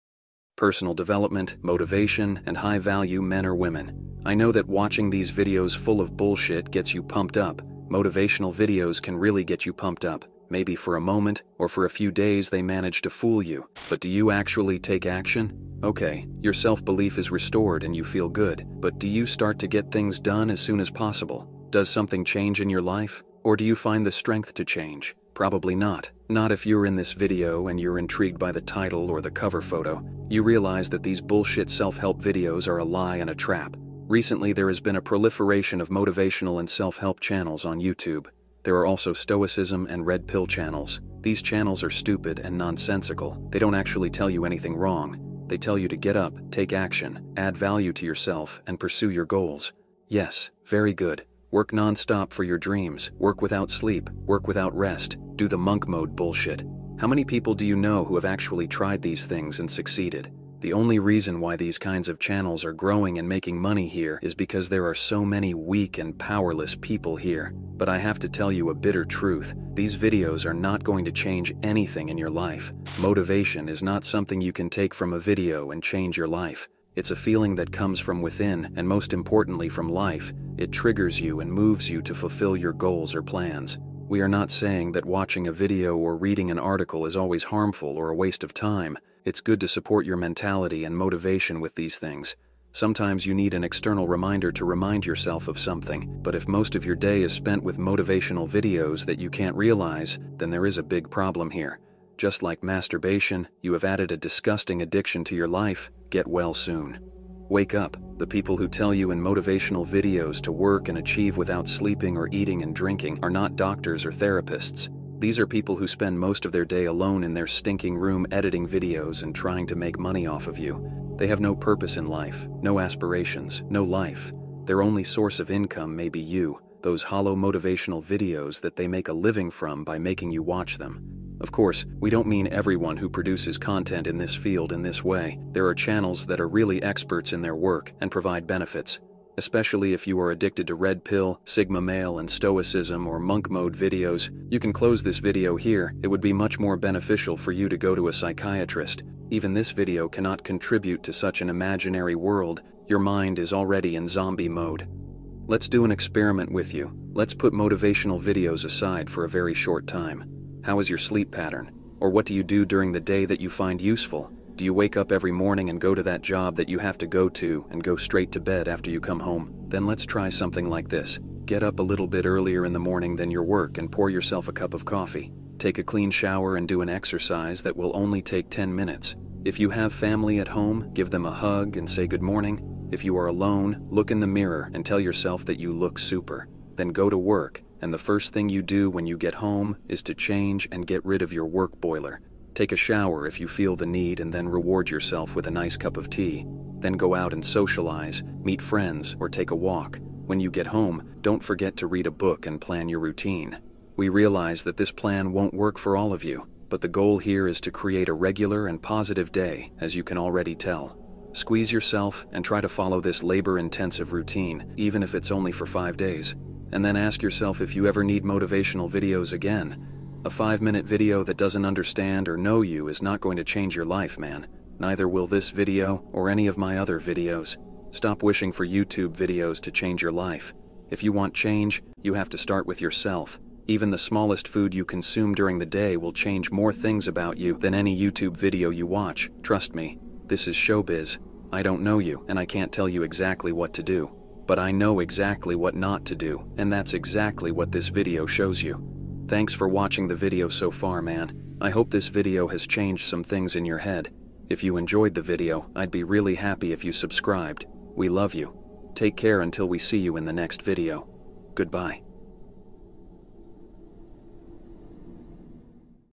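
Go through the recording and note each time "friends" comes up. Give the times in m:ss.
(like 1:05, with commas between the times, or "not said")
3:18.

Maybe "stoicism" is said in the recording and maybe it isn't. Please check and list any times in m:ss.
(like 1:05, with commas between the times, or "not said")
0:39, 2:22.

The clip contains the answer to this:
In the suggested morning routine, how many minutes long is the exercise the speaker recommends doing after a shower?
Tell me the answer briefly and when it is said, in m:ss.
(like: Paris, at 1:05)
10, at 2:58.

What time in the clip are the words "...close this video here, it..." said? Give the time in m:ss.
2:24.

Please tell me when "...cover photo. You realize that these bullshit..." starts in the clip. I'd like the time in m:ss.
0:29.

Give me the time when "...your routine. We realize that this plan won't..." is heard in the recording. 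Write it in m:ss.
3:22.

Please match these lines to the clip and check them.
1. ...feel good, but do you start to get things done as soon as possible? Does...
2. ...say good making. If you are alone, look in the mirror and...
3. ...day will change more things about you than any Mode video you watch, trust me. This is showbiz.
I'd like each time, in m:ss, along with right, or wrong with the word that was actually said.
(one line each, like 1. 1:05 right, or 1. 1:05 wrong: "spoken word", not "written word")
1. 0:18 right
2. 3:01 wrong: "morning", not "making"
3. 3:55 wrong: "YouTube", not "Mode".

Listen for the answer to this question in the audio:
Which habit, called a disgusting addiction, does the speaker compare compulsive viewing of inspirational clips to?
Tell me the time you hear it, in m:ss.
1:42.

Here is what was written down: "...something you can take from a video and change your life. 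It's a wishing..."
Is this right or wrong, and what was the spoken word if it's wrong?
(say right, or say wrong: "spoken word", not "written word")
wrong: "feeling", not "wishing".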